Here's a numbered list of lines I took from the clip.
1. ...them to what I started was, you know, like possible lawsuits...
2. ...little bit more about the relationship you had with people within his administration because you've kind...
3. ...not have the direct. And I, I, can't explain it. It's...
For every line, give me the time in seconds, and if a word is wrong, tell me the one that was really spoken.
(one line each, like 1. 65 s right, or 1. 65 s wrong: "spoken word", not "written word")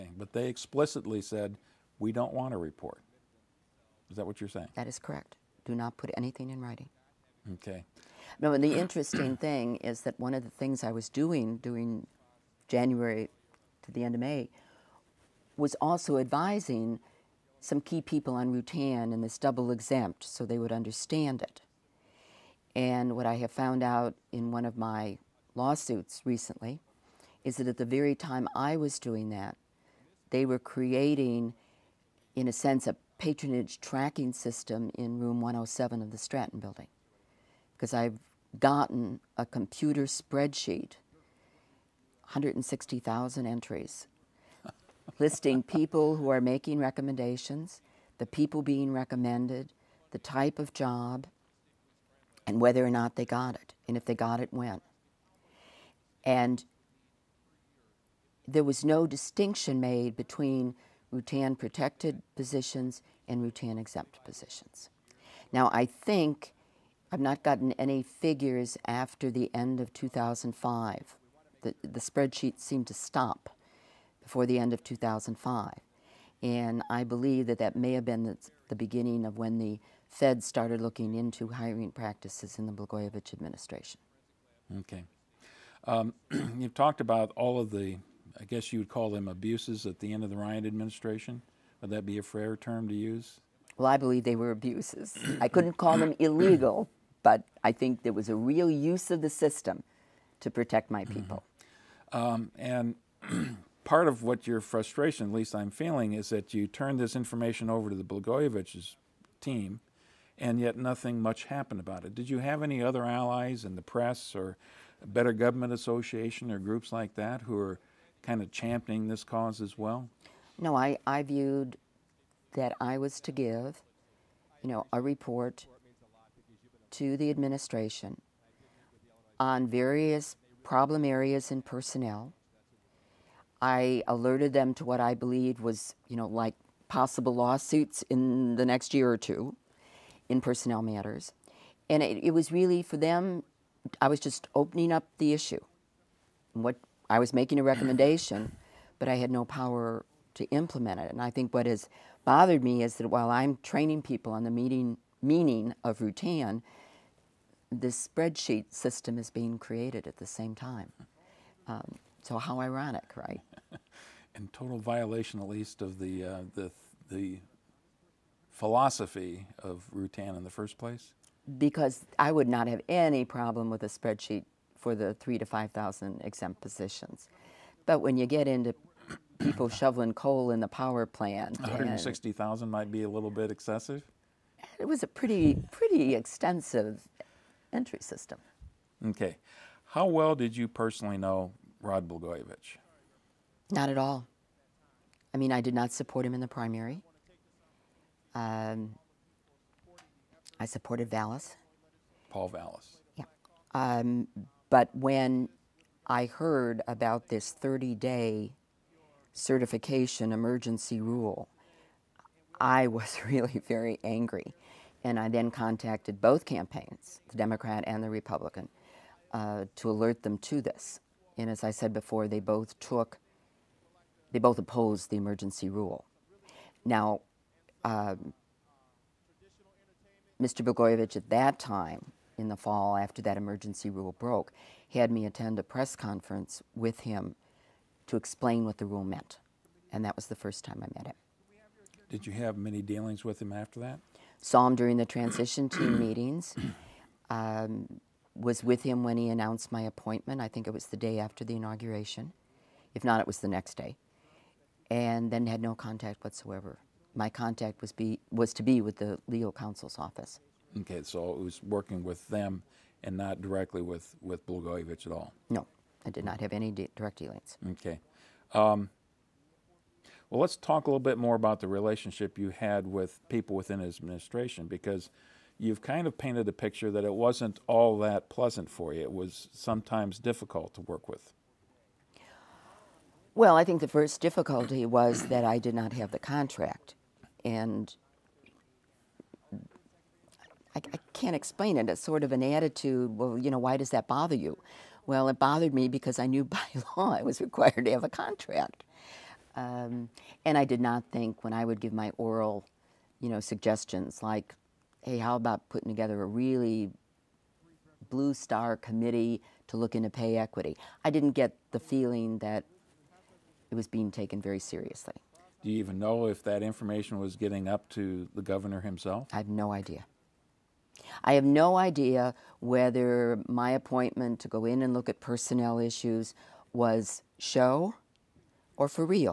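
1. 134 s wrong: "believed", not "started"
2. 270 s right
3. 285 s wrong: "contract", not "direct".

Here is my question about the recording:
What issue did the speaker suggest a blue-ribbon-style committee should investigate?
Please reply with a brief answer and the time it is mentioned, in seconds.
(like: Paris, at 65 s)
Pay equity, at 310 s.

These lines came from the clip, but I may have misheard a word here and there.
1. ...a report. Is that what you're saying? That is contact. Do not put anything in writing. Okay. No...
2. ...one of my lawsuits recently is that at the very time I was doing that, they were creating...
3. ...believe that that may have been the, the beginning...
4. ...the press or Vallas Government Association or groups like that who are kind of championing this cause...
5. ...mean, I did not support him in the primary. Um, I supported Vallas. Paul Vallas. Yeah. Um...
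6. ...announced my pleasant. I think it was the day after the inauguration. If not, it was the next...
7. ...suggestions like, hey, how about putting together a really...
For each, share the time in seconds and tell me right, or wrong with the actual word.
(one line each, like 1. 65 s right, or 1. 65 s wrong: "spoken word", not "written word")
1. 2 s wrong: "correct", not "contact"
2. 24 s right
3. 77 s right
4. 113 s wrong: "Better", not "Vallas"
5. 195 s right
6. 249 s wrong: "appointment", not "pleasant"
7. 303 s right.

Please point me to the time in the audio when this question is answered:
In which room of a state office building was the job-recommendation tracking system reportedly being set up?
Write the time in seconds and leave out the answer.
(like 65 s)
35 s.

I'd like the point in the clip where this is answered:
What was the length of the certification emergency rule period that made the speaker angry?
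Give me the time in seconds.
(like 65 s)
207 s.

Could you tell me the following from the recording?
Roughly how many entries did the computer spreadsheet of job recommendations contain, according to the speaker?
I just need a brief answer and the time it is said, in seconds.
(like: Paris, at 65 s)
160,000, at 42 s.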